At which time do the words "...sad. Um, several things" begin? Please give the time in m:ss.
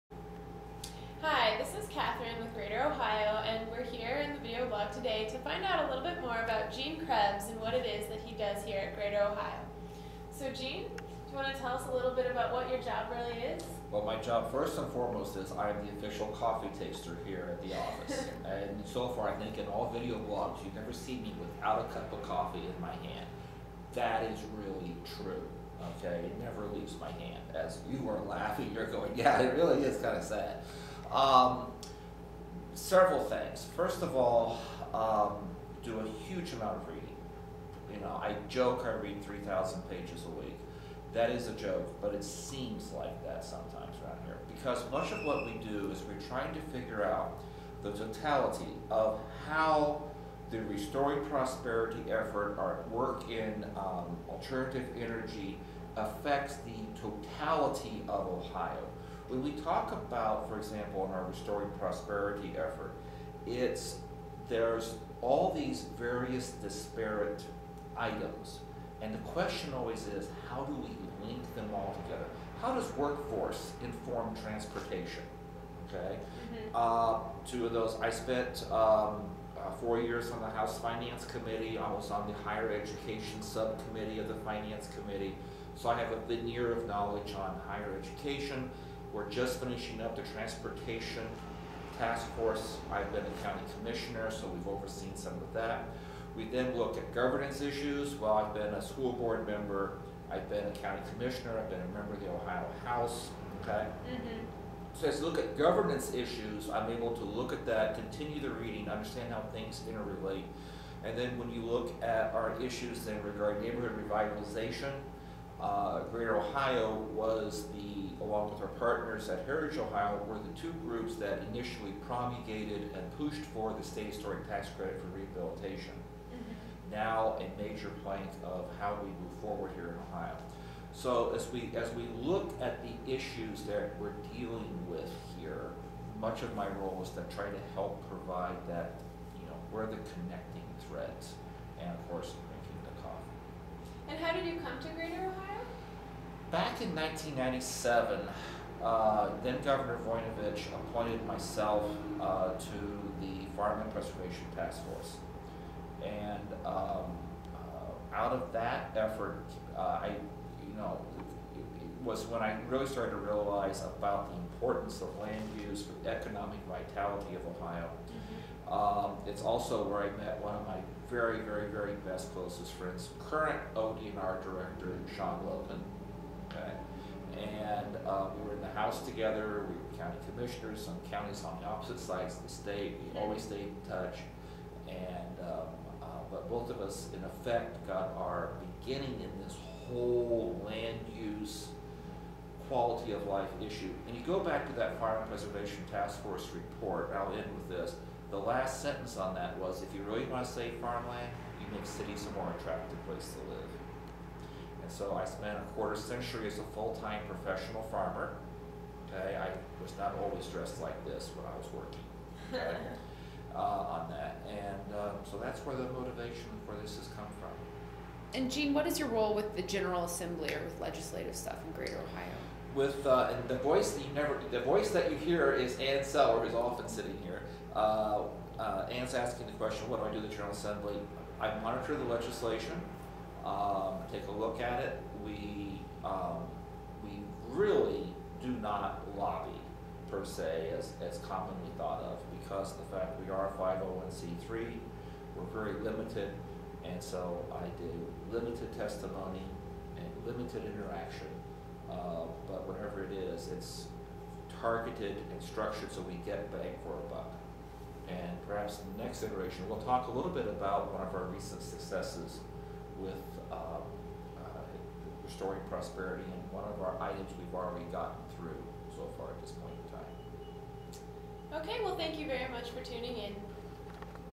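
0:30.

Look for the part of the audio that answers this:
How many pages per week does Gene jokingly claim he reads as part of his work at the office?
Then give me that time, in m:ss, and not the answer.
0:39.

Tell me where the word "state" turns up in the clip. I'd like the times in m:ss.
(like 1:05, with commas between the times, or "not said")
2:03, 3:02.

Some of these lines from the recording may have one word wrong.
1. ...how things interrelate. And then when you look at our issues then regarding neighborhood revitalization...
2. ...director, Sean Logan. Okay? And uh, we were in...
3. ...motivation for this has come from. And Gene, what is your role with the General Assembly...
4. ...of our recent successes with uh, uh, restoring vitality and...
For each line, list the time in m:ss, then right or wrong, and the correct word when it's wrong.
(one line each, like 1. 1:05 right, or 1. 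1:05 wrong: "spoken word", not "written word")
1. 1:49 right
2. 2:54 right
3. 3:35 right
4. 4:21 wrong: "prosperity", not "vitality".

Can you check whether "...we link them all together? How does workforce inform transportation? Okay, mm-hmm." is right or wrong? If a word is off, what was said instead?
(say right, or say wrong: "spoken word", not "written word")
right.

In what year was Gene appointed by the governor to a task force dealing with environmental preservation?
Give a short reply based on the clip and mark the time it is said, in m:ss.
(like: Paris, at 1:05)
1997, at 2:26.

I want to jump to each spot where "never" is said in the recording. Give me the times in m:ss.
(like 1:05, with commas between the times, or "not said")
0:20, 0:26, 3:44.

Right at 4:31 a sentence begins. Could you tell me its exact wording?
Okay, well, thank you very much for tuning in.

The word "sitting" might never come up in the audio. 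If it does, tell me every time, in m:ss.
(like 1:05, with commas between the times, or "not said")
3:46.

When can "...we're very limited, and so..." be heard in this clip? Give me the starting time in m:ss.
4:05.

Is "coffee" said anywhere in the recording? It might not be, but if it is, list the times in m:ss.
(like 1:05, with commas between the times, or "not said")
0:16, 0:22.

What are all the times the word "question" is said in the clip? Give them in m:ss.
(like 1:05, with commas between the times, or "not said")
1:09, 3:49.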